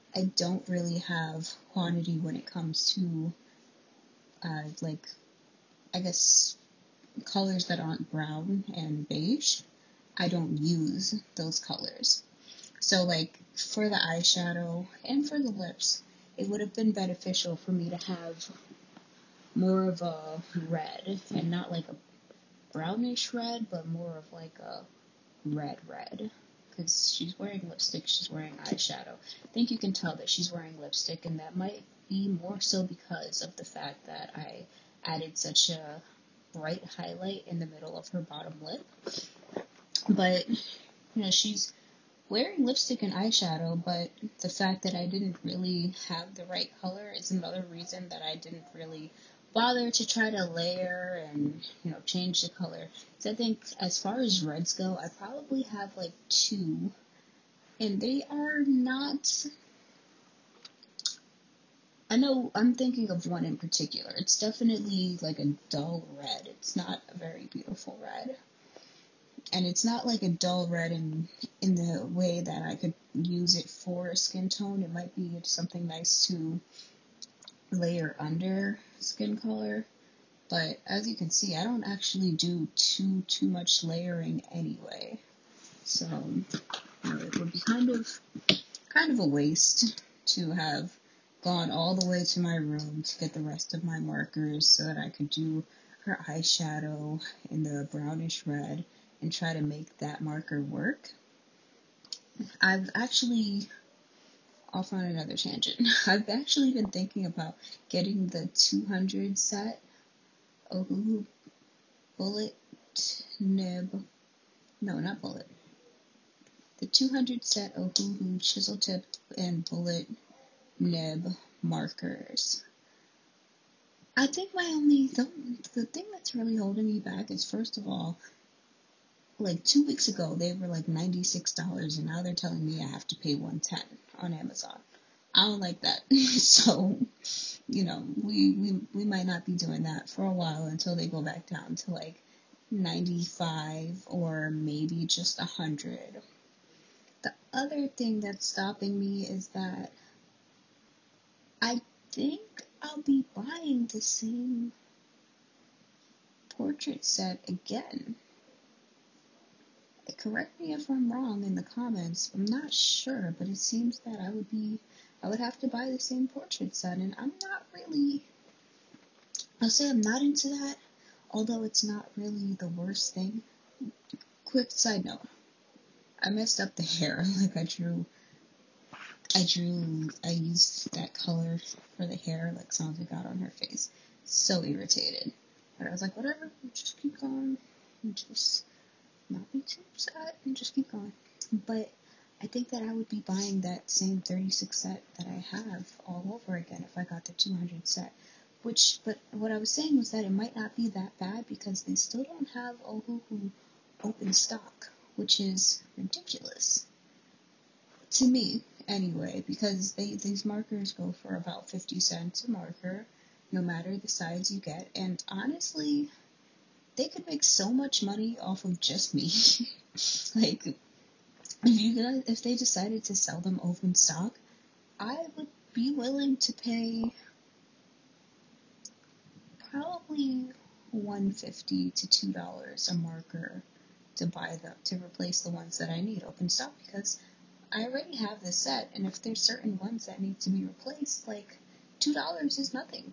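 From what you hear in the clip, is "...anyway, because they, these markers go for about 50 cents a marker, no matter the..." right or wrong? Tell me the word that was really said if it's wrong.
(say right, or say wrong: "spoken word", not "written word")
right.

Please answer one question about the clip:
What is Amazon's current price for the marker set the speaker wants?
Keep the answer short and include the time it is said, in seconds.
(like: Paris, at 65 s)
$110, at 133 s.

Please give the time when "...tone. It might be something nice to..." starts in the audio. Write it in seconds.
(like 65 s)
74 s.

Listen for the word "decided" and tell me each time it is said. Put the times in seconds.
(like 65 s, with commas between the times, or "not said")
222 s.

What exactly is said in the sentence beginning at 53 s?
So I think as far as reds go, I probably have like two, and they are not.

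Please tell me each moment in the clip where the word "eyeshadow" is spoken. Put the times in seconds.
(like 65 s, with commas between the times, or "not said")
13 s, 28 s, 43 s, 96 s.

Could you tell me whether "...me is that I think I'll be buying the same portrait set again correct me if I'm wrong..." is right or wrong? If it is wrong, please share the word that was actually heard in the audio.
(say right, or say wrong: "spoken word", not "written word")
right.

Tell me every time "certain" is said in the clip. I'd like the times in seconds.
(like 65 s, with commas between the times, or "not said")
239 s.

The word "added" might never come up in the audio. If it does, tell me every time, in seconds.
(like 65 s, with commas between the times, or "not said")
35 s.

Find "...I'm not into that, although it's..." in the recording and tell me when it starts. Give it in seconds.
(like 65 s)
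169 s.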